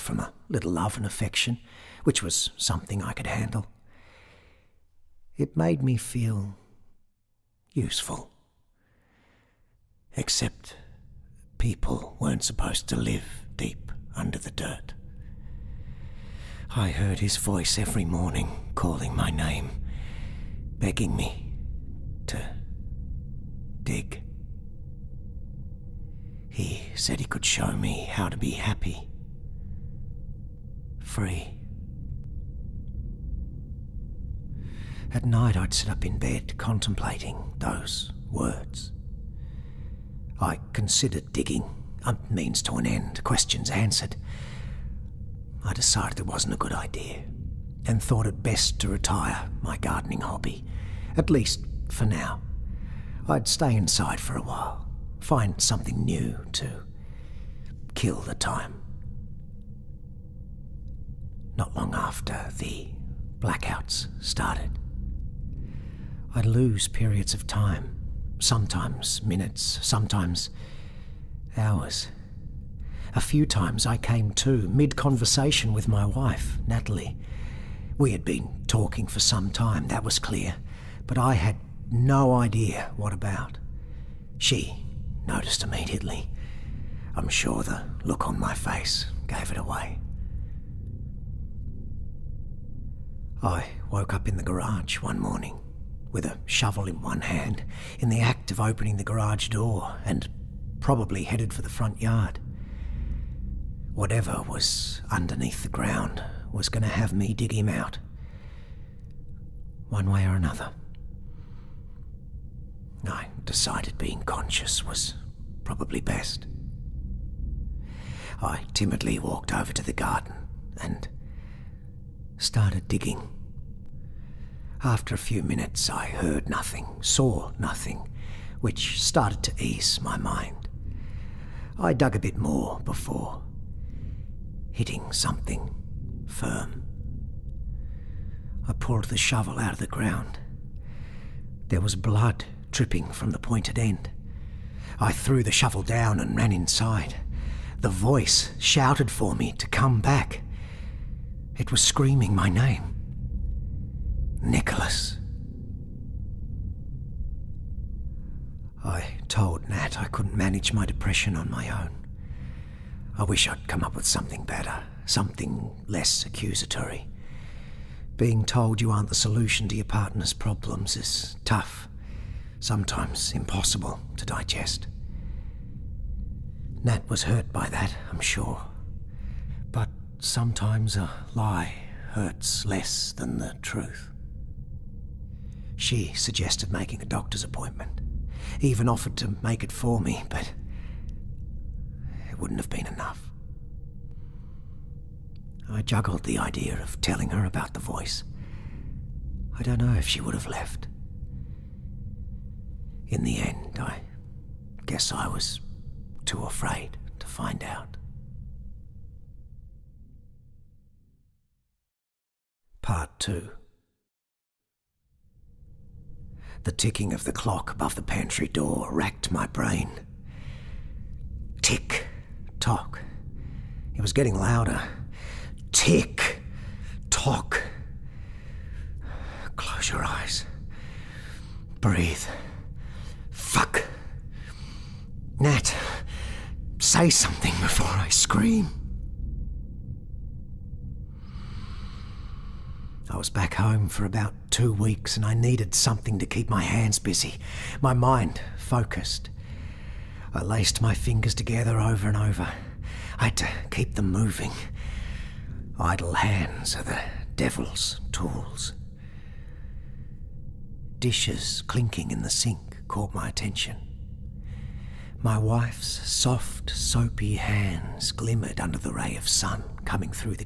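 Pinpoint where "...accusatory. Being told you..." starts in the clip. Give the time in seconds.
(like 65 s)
166 s.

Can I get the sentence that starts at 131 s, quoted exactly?
I dug a bit more before hitting something firm.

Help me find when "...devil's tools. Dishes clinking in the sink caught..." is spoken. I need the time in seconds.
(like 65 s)
257 s.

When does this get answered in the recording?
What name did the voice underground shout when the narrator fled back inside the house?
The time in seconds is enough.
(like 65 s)
154 s.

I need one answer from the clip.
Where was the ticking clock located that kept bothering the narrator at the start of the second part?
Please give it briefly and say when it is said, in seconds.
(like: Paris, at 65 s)
above the pantry door, at 217 s.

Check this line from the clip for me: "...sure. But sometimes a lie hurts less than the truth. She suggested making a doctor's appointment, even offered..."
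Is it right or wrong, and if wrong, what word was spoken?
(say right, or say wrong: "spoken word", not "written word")
right.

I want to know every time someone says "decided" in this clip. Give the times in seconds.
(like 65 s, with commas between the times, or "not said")
45 s, 113 s.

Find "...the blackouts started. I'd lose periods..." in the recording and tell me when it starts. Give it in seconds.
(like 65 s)
62 s.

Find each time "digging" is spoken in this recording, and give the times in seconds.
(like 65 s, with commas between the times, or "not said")
41 s, 122 s.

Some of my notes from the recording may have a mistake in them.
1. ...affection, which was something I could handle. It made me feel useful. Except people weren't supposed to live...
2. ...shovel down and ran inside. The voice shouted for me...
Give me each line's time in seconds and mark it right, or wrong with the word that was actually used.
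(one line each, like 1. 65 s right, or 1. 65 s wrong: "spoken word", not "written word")
1. 1 s right
2. 145 s right.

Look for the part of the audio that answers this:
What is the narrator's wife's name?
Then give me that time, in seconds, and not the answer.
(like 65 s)
76 s.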